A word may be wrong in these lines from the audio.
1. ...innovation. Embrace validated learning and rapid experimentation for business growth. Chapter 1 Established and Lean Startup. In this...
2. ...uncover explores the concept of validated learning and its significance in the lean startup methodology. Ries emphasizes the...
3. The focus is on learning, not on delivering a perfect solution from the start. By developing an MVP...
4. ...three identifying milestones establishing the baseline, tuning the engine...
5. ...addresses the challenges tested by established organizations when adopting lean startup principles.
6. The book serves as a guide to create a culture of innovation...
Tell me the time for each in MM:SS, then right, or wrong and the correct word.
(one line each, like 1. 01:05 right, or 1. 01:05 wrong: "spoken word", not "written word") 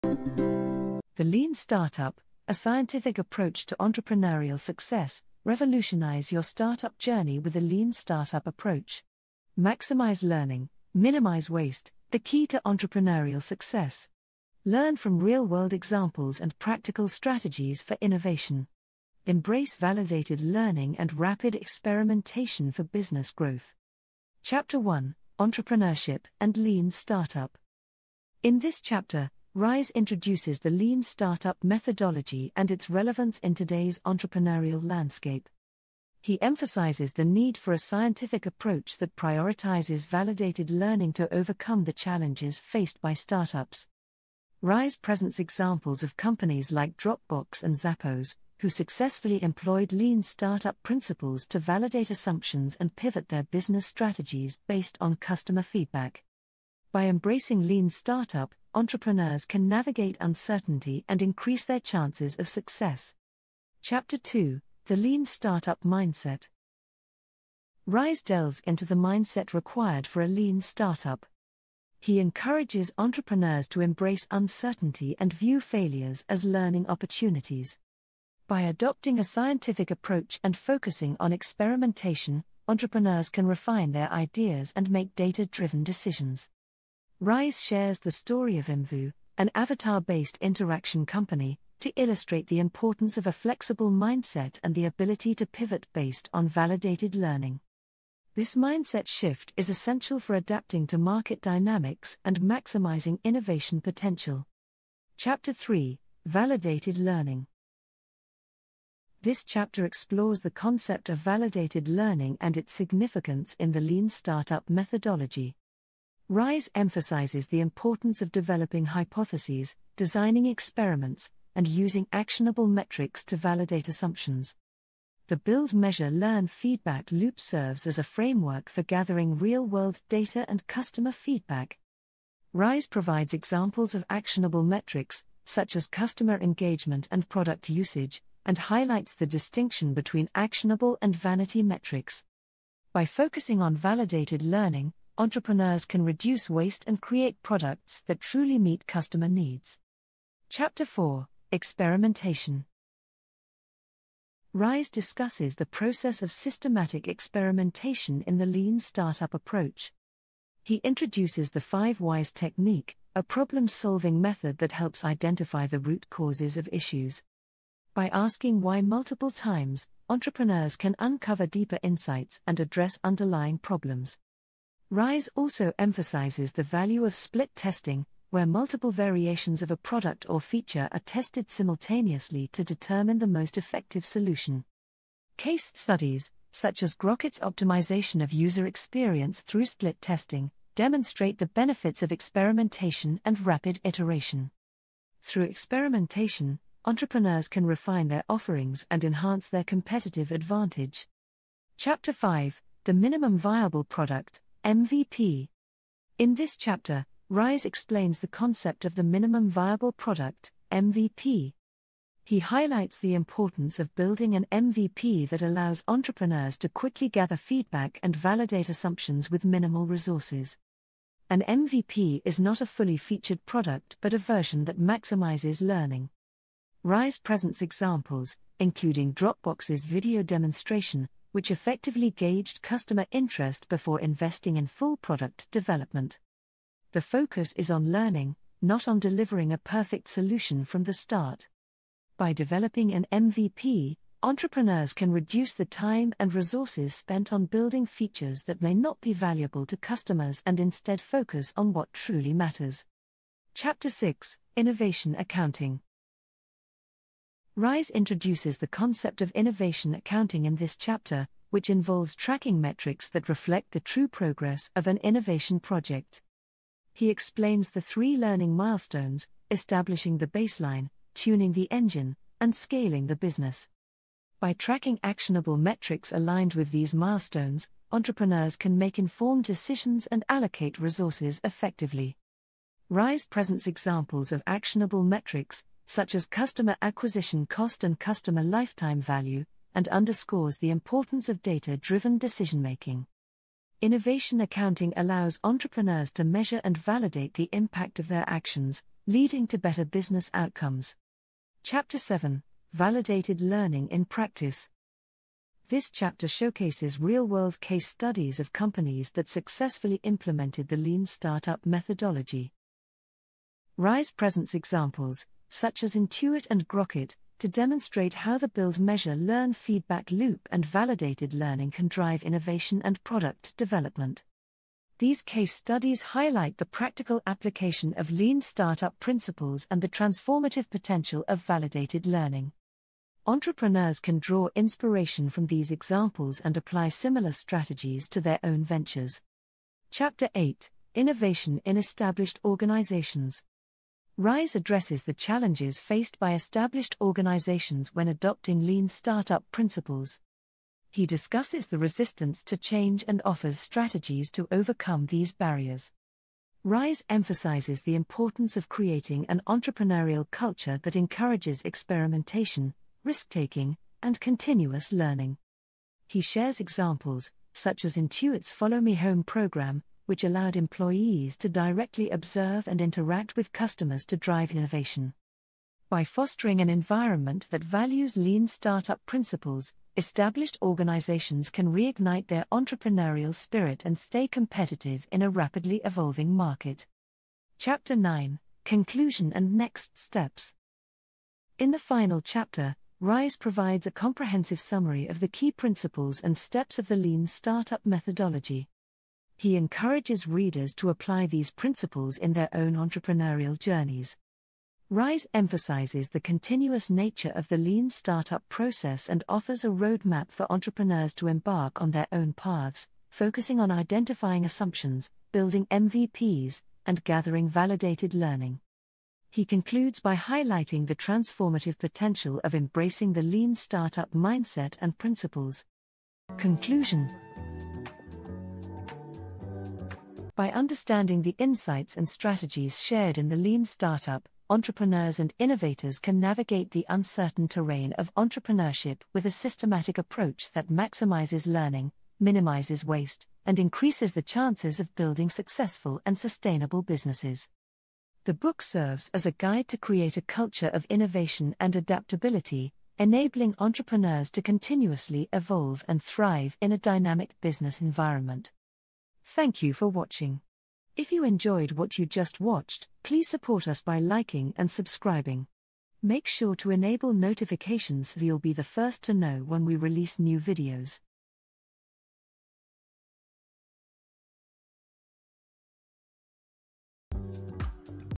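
1. 00:18 wrong: "Entrepreneurship", not "Established"
2. 01:49 wrong: "chapter", not "uncover"
3. 03:56 right
4. 04:27 wrong: "learning", not "identifying"
5. 05:44 wrong: "faced", not "tested"
6. 07:28 right.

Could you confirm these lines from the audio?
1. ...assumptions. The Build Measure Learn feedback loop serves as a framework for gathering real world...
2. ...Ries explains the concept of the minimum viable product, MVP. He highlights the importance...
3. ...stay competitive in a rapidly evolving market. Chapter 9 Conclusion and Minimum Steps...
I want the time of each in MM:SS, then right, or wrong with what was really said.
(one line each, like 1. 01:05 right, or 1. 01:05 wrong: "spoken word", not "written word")
1. 02:03 right
2. 03:27 right
3. 06:23 wrong: "Next", not "Minimum".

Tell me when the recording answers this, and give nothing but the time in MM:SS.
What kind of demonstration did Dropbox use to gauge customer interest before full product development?
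03:49.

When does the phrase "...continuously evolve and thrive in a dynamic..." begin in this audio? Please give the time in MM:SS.
07:34.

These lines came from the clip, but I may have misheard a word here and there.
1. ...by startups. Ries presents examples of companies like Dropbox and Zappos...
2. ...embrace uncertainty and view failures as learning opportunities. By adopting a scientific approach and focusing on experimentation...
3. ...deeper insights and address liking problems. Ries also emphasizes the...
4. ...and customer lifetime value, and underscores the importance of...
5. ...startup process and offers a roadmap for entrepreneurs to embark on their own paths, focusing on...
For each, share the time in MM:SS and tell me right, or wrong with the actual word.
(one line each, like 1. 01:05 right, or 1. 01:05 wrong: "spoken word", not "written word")
1. 00:43 right
2. 01:13 right
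3. 02:51 wrong: "underlying", not "liking"
4. 04:47 right
5. 06:47 right.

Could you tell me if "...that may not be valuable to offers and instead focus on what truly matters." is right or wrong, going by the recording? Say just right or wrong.
wrong.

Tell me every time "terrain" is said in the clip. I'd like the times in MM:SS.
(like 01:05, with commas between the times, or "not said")
07:17.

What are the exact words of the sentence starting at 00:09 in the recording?
Maximize learning, minimize waste, the key to entrepreneurial success.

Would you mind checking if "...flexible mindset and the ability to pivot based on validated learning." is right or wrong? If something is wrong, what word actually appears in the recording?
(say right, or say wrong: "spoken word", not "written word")
right.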